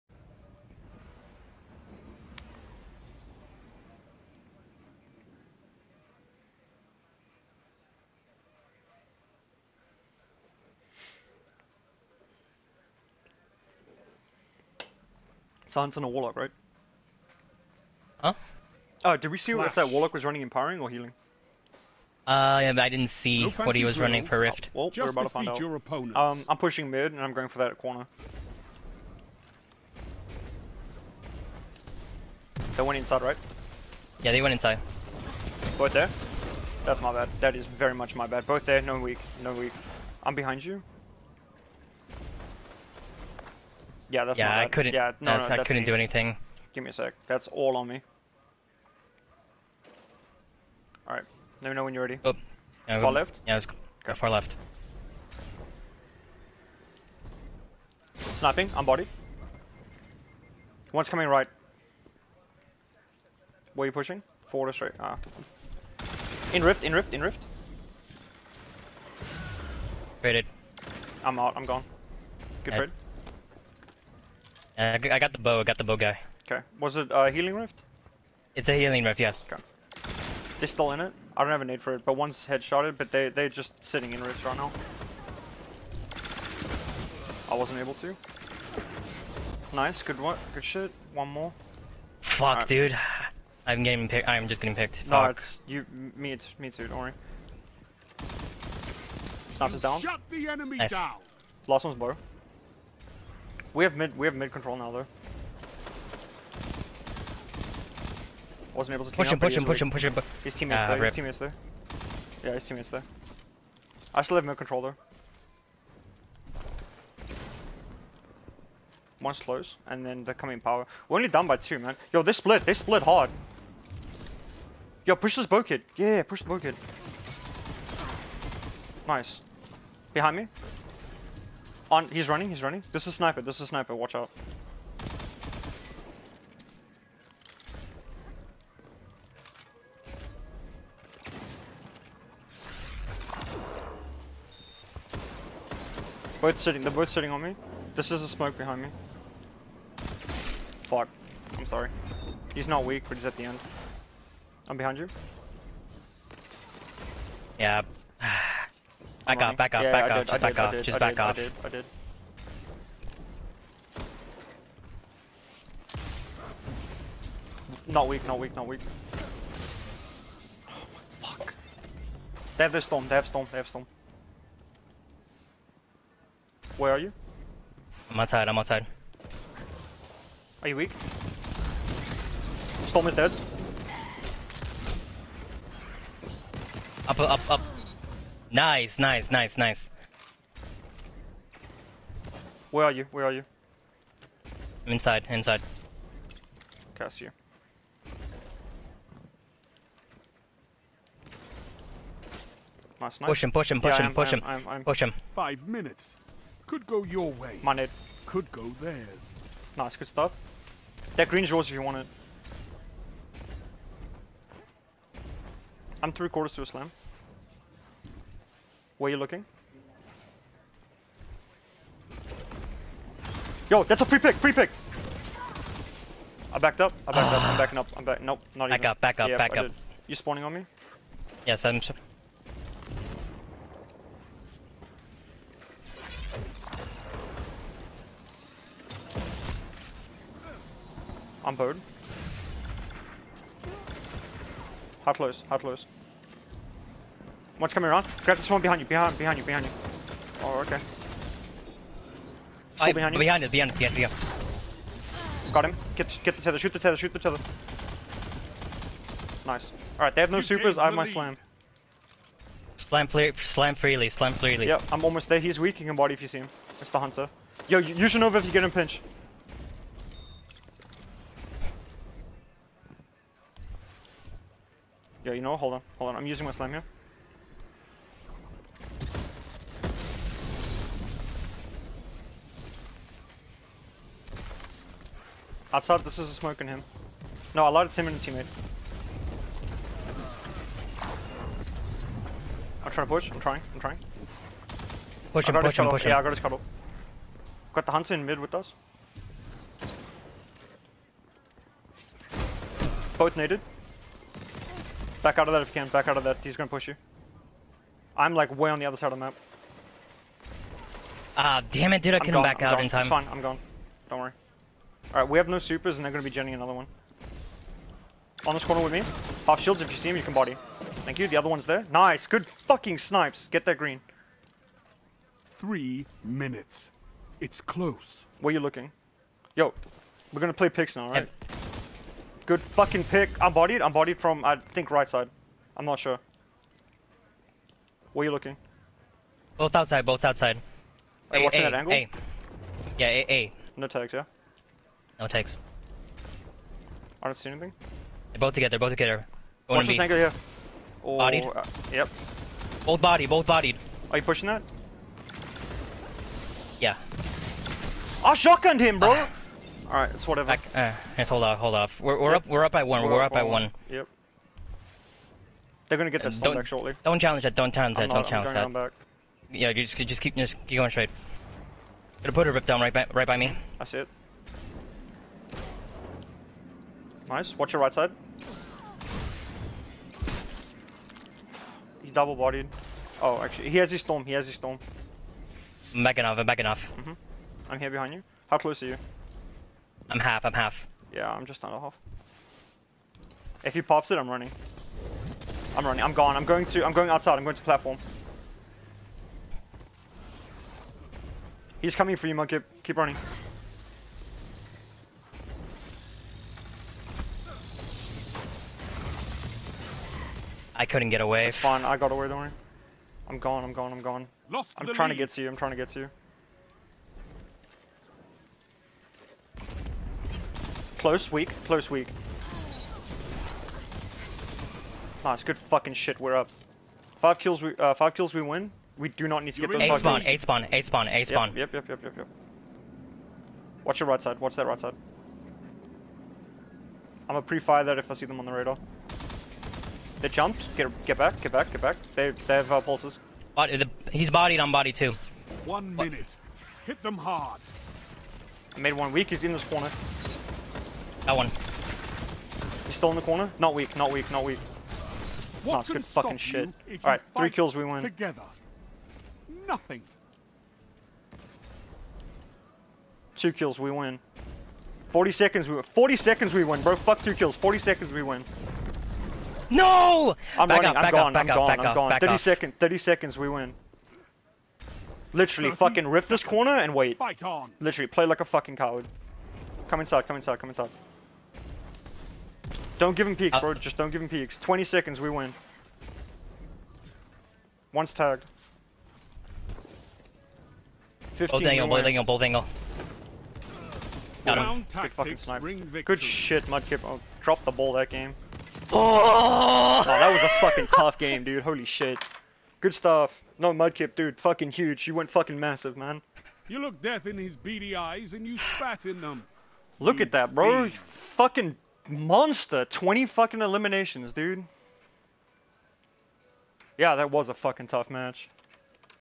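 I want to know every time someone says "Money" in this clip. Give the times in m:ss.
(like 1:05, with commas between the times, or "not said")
3:27.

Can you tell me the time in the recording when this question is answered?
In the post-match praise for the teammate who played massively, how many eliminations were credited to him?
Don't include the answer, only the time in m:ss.
8:32.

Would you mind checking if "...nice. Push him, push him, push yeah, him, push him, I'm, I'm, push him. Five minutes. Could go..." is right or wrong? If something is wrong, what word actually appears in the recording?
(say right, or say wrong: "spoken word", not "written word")
right.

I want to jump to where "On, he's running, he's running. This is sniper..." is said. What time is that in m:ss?
2:11.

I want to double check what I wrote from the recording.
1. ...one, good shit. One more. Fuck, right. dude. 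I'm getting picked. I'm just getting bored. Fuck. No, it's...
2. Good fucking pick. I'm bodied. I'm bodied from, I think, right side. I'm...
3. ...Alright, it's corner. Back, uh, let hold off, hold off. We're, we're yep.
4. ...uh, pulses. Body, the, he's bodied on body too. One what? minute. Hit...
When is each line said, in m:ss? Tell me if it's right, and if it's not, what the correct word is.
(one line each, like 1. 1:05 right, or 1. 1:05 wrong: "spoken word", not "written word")
1. 1:30 wrong: "picked", not "bored"
2. 5:32 right
3. 5:59 wrong: "whatever", not "corner"
4. 7:22 right.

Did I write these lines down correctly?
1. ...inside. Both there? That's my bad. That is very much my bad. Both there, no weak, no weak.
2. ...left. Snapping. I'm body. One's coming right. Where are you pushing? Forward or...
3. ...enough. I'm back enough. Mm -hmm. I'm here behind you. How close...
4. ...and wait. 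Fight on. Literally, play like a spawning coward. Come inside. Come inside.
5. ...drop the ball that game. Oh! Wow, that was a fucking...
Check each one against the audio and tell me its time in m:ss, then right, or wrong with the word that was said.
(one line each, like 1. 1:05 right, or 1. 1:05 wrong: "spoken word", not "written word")
1. 0:34 right
2. 0:54 right
3. 6:26 right
4. 7:56 wrong: "fucking", not "spawning"
5. 8:17 right.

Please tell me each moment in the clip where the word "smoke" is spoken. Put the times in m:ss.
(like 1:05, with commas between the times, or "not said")
2:28, 4:46.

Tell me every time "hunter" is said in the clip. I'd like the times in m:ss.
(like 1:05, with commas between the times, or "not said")
4:26, 4:57.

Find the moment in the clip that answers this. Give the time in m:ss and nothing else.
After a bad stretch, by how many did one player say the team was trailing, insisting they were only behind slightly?
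2:01.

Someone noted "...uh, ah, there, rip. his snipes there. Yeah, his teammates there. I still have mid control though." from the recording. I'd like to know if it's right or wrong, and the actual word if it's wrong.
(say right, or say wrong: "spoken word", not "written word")
wrong: "teammates", not "snipes".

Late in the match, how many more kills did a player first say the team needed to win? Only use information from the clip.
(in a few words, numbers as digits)
5.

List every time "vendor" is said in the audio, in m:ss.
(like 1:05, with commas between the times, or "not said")
not said.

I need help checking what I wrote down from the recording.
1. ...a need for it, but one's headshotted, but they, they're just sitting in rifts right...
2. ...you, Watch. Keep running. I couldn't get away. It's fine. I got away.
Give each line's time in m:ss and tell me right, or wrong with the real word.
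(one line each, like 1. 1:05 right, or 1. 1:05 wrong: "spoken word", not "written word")
1. 1:21 right
2. 6:42 wrong: "Monkey", not "Watch".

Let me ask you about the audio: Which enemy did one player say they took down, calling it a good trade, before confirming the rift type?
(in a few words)
The bow guy.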